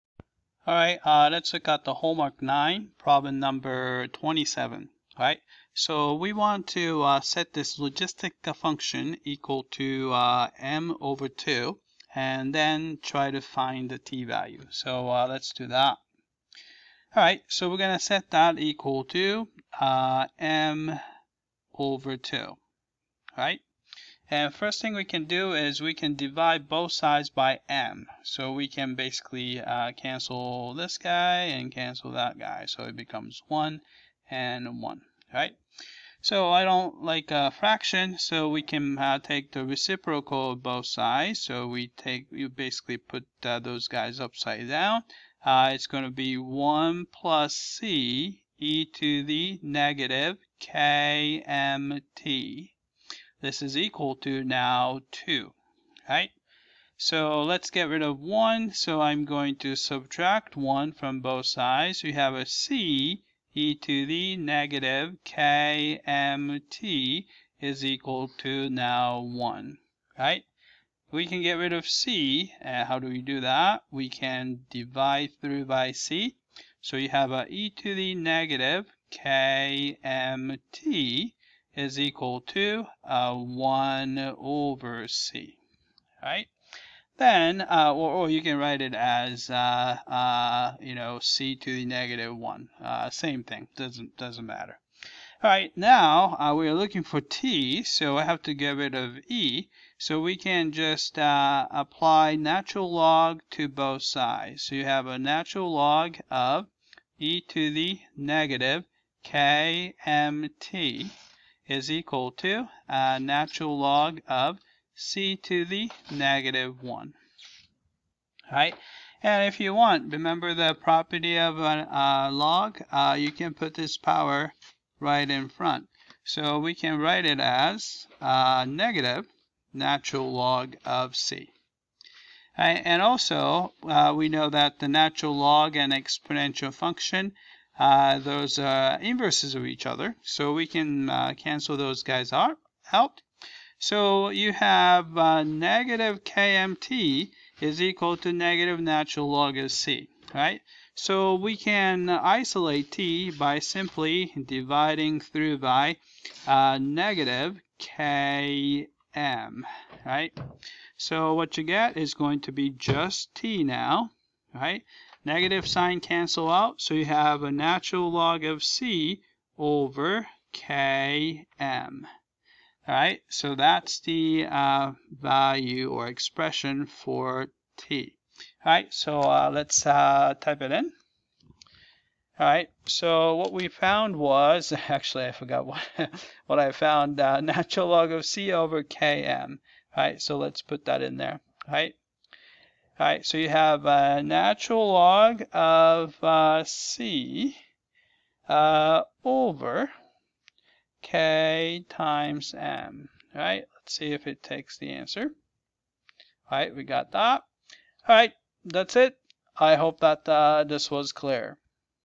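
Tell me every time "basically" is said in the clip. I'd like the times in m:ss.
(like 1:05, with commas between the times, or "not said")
0:28, 0:42.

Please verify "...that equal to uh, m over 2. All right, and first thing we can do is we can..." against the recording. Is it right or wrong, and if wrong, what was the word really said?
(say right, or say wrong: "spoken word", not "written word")
right.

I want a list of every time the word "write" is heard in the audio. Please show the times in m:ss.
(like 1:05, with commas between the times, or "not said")
1:28, 2:06.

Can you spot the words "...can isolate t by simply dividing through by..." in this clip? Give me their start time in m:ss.
2:31.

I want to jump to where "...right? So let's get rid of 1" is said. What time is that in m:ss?
0:56.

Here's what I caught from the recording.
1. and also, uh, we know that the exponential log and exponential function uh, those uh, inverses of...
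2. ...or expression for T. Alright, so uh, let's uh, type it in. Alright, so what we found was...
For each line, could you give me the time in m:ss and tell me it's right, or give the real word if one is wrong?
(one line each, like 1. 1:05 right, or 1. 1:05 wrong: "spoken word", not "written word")
1. 2:12 wrong: "natural", not "exponential"
2. 2:55 right.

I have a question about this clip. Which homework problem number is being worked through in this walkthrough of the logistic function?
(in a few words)
27.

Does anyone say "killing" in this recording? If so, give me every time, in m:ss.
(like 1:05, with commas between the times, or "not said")
not said.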